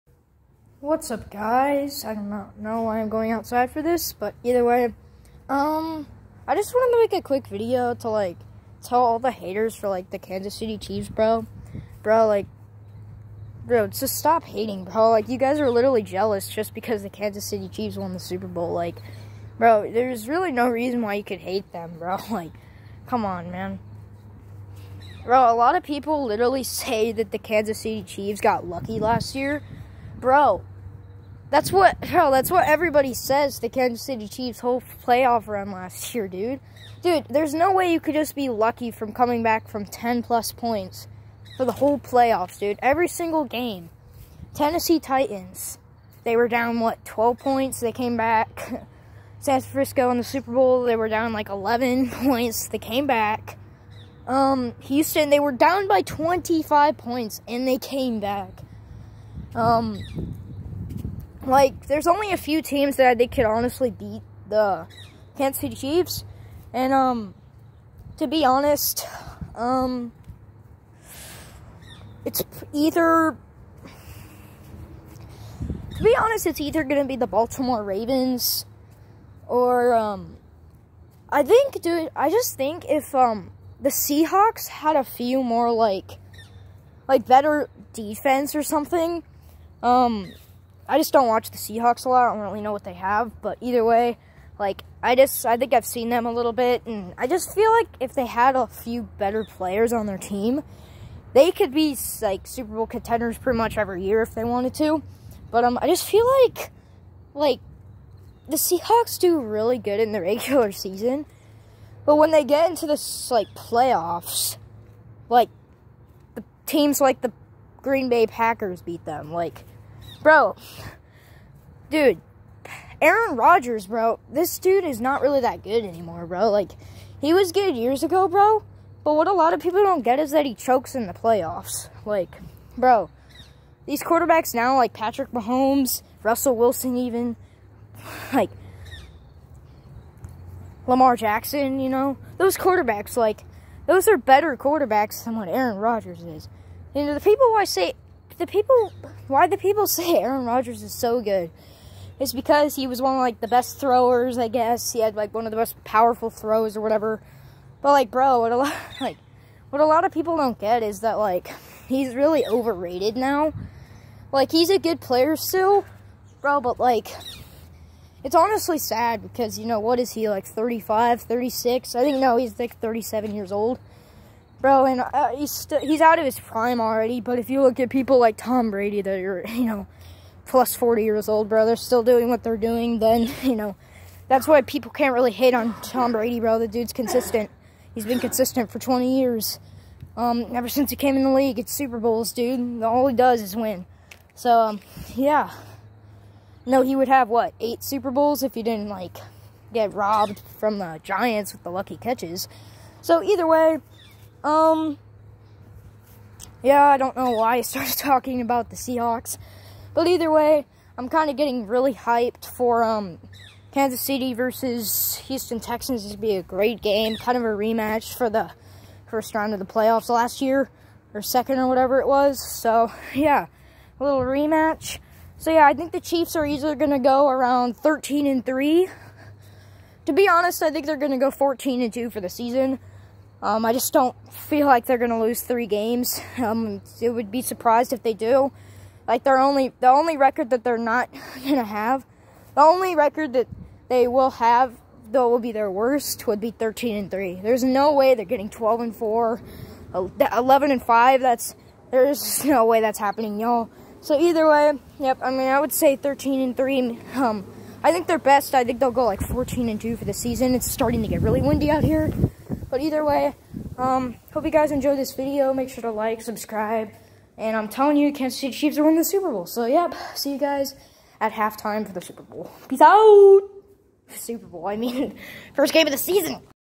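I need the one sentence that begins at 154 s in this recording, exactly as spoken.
He had like one of the most powerful throws or whatever.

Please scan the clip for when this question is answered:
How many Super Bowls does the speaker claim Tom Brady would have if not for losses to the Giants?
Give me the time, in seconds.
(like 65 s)
197 s.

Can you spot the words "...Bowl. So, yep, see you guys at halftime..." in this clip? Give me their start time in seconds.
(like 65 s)
269 s.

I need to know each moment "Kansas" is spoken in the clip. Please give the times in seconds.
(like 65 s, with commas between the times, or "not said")
10 s, 17 s, 27 s, 33 s, 65 s, 213 s, 268 s.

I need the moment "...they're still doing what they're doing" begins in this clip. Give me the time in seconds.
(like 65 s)
181 s.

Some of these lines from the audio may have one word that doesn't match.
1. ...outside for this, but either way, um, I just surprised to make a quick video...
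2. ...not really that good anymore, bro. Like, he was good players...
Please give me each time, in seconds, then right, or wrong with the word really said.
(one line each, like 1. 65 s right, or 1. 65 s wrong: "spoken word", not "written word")
1. 3 s wrong: "wanted", not "surprised"
2. 125 s wrong: "years", not "players".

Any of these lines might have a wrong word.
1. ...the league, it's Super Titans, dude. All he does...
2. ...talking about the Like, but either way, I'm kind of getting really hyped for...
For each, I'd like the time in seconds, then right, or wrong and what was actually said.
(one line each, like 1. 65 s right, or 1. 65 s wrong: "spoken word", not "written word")
1. 191 s wrong: "Bowls", not "Titans"
2. 207 s wrong: "Seahawks", not "Like".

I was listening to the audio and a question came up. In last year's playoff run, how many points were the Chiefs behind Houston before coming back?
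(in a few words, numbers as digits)
25.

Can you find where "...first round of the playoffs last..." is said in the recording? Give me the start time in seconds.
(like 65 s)
219 s.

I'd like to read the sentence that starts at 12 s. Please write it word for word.
Bro, like, bro, just stop hating, bro.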